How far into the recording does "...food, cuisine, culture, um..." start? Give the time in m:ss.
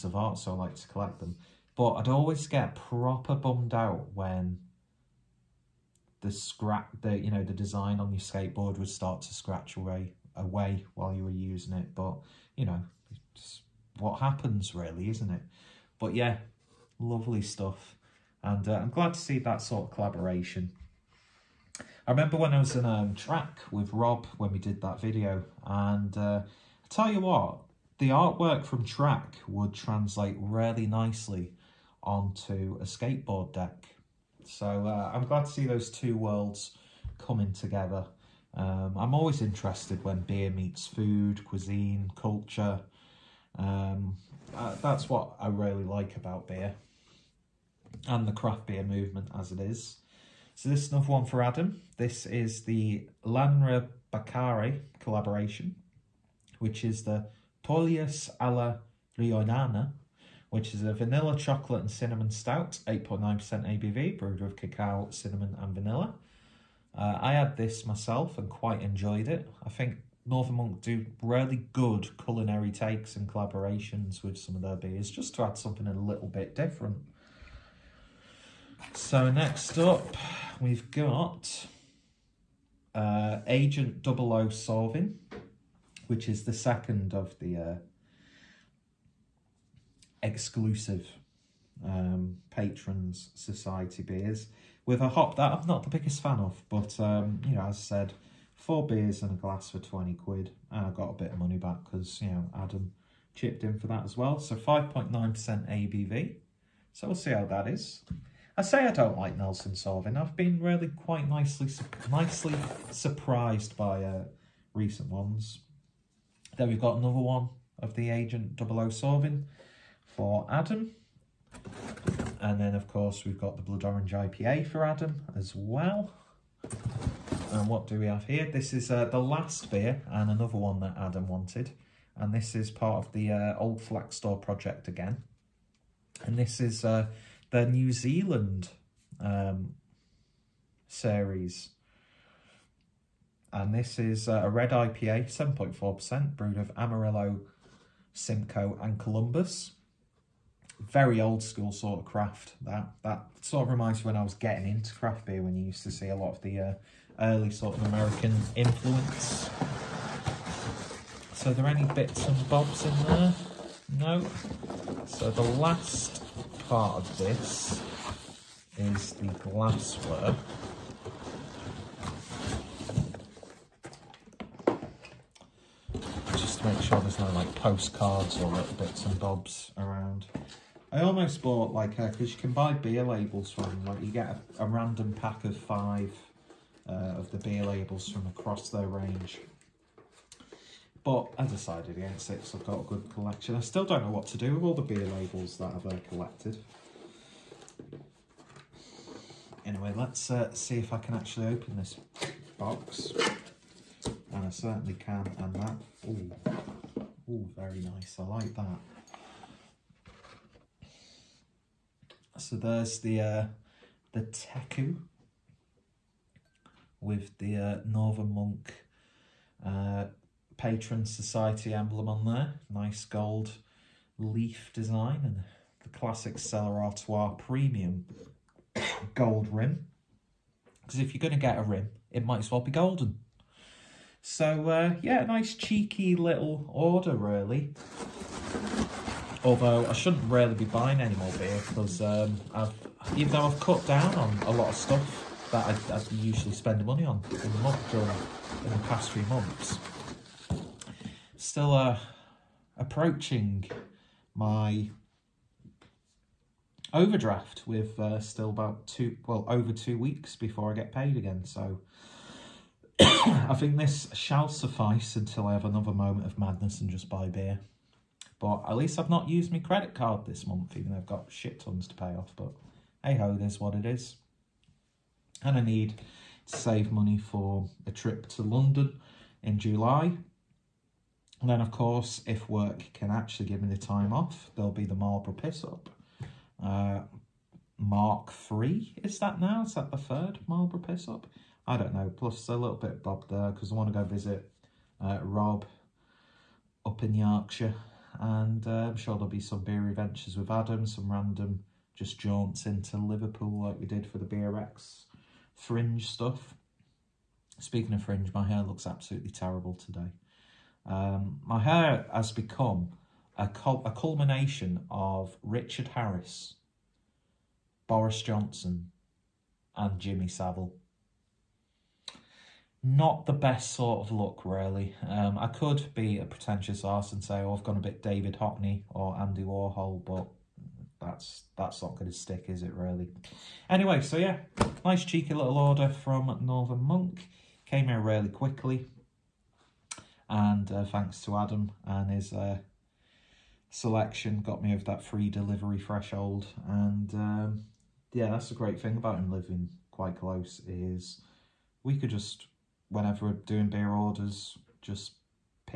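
0:40.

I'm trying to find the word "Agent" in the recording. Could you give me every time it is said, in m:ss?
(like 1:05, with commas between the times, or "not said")
1:23, 1:58.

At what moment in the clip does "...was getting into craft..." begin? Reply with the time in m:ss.
2:34.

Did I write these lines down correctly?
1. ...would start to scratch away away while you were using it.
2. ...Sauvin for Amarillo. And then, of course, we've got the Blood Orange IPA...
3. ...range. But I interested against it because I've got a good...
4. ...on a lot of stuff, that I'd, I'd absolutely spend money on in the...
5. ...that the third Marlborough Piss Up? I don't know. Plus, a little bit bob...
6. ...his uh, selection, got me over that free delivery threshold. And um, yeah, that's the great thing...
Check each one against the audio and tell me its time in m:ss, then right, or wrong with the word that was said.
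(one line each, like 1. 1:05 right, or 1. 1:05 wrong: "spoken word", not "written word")
1. 0:08 right
2. 1:58 wrong: "Adam", not "Amarillo"
3. 3:08 wrong: "decided", not "interested"
4. 4:04 wrong: "usually", not "absolutely"
5. 4:49 right
6. 5:42 right.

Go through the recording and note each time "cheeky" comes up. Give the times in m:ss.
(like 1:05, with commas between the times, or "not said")
3:55, 5:35.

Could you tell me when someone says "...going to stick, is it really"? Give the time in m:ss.
5:31.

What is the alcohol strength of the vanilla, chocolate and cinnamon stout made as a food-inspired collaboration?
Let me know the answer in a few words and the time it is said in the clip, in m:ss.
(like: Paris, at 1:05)
8.9%, at 1:02.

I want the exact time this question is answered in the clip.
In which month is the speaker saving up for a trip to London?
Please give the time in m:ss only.
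4:39.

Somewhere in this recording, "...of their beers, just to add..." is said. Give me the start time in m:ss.
1:14.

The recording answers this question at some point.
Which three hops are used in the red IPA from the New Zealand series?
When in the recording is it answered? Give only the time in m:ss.
2:26.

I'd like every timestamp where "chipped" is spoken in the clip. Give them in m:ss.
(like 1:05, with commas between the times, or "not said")
1:43.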